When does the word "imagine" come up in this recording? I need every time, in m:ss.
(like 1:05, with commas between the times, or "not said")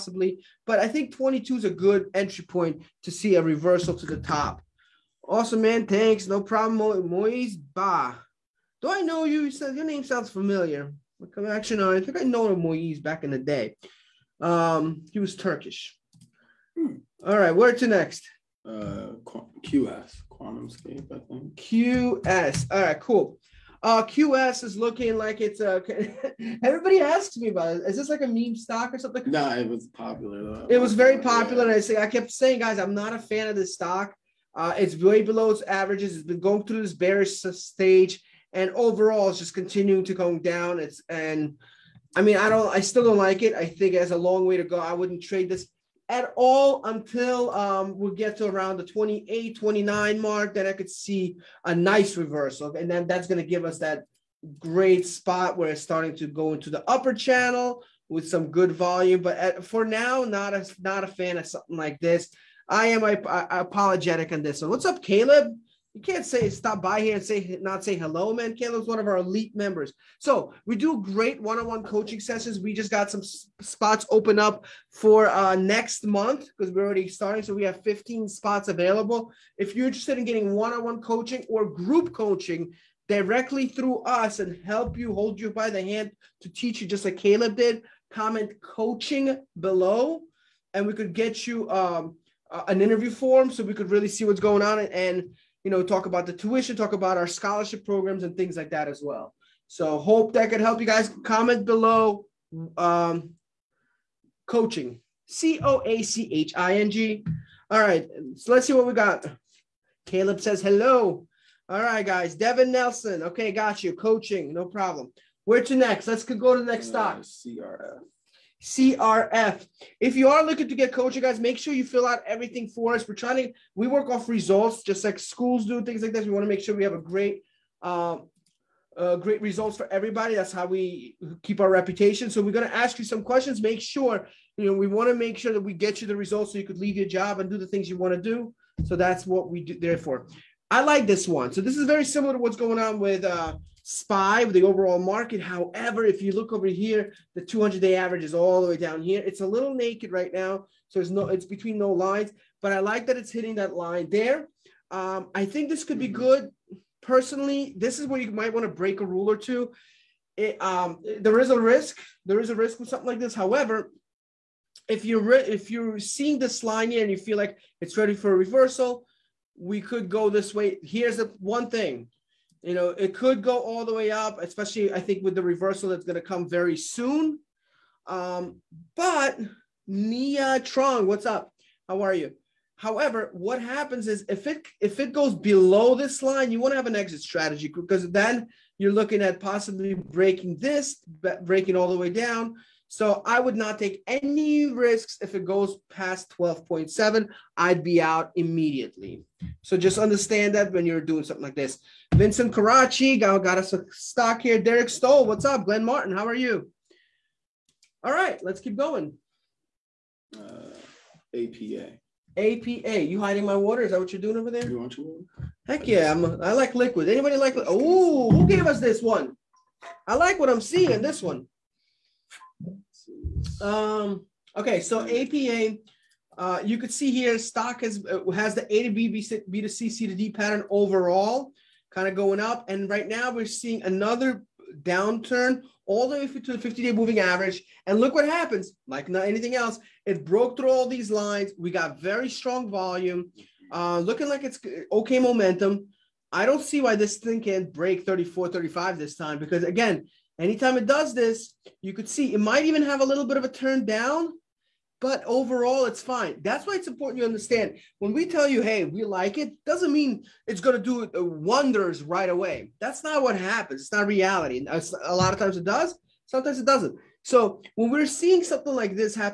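not said.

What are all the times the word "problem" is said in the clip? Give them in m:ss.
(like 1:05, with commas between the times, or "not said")
0:06, 1:54.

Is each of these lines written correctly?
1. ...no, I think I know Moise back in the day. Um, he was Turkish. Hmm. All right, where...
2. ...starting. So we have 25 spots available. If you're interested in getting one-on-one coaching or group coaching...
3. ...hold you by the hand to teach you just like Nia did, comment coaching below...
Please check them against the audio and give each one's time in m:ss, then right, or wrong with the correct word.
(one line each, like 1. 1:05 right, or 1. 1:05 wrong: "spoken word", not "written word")
1. 0:11 right
2. 1:17 wrong: "15", not "25"
3. 1:25 wrong: "Caleb", not "Nia".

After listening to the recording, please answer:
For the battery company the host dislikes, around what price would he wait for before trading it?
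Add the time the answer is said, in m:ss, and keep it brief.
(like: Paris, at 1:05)
28, 29, at 0:48.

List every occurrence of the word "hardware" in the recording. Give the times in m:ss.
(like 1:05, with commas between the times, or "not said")
not said.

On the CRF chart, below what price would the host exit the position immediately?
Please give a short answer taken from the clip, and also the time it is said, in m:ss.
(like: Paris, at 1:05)
12.7, at 3:16.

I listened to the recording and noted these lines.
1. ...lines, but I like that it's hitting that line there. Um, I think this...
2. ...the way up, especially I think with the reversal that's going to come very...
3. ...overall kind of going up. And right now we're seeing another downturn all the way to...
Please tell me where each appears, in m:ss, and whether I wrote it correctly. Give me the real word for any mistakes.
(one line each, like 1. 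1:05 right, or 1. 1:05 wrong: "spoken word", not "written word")
1. 2:31 right
2. 2:53 right
3. 3:50 right.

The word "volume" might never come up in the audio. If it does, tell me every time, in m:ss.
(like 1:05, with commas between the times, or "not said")
0:58, 4:02.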